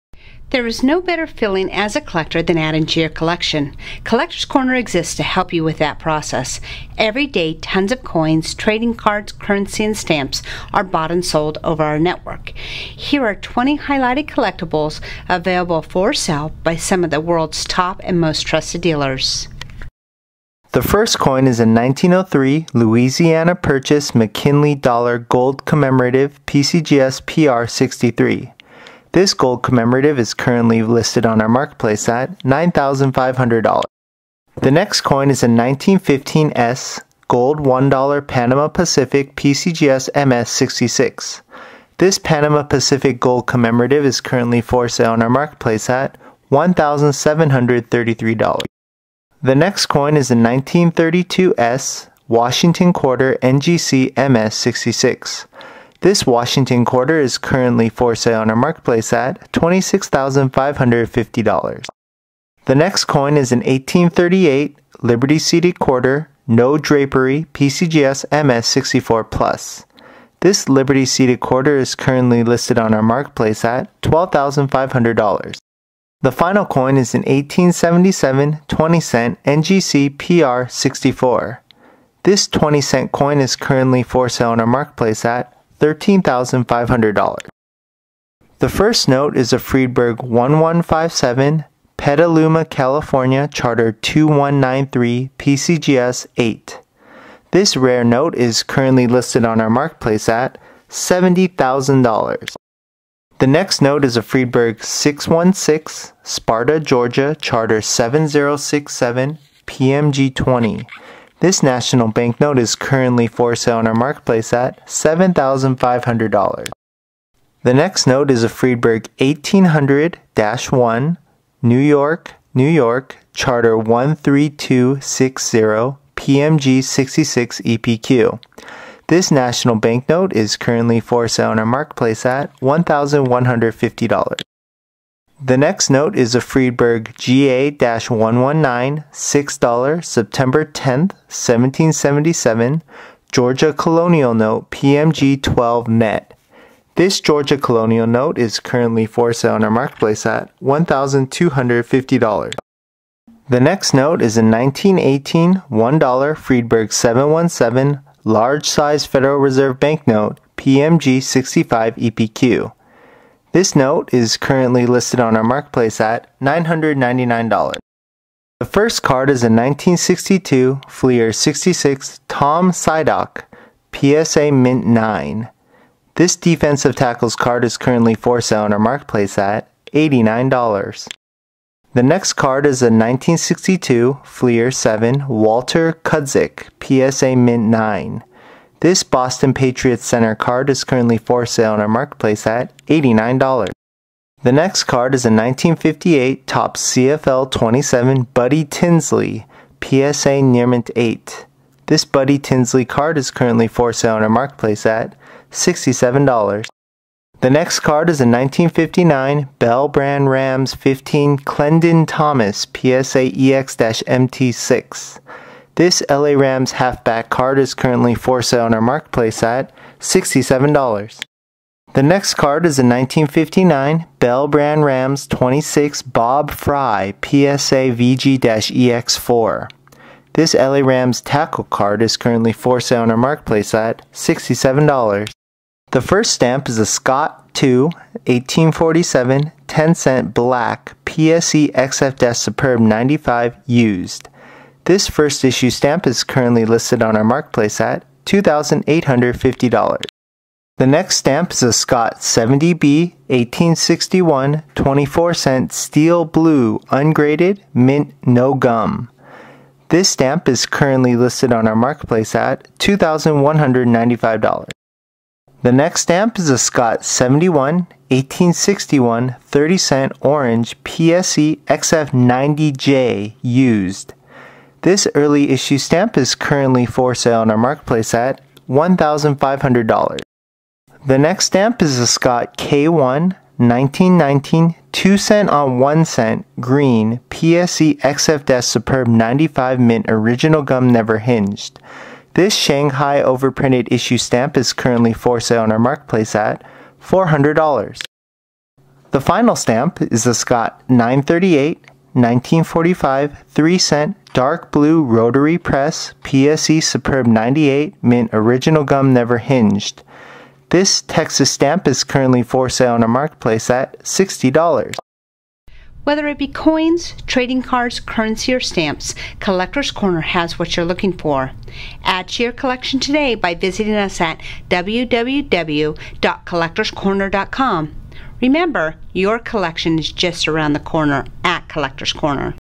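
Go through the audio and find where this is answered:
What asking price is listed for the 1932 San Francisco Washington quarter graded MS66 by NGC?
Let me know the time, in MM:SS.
00:59.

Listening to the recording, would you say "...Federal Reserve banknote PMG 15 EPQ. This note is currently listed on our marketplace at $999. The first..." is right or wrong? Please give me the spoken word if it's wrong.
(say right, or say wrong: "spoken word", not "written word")
wrong: "65", not "15".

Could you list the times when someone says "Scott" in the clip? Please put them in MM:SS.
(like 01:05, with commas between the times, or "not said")
03:56, 04:11, 04:26, 04:42, 05:00.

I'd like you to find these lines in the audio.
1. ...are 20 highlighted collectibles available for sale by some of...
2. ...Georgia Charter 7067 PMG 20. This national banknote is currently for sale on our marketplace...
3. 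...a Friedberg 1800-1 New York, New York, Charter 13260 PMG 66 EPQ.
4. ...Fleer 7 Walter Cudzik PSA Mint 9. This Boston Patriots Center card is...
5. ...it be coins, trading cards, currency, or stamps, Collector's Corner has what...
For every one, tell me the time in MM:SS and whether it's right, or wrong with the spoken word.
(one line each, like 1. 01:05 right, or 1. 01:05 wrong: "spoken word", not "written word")
1. 00:13 right
2. 01:46 right
3. 01:58 right
4. 03:04 right
5. 05:16 right.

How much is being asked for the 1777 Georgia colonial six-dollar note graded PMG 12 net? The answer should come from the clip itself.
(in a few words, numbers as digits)
$1,250.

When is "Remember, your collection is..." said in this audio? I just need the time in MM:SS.
05:28.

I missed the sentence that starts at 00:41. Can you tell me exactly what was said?
This Panama Pacific gold commemorative is currently for sale on our marketplace at $1,733.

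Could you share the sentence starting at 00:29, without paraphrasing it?
This gold commemorative is currently listed on our marketplace at $9,500.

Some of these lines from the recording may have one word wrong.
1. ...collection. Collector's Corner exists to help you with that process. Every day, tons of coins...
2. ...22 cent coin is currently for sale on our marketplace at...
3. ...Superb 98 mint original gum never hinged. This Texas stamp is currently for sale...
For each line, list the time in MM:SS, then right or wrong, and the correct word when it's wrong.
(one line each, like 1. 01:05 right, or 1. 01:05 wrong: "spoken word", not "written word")
1. 00:03 right
2. 01:22 wrong: "20", not "22"
3. 05:06 right.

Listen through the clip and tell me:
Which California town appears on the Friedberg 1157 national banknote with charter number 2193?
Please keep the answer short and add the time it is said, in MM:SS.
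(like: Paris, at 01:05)
Petaluma, at 01:31.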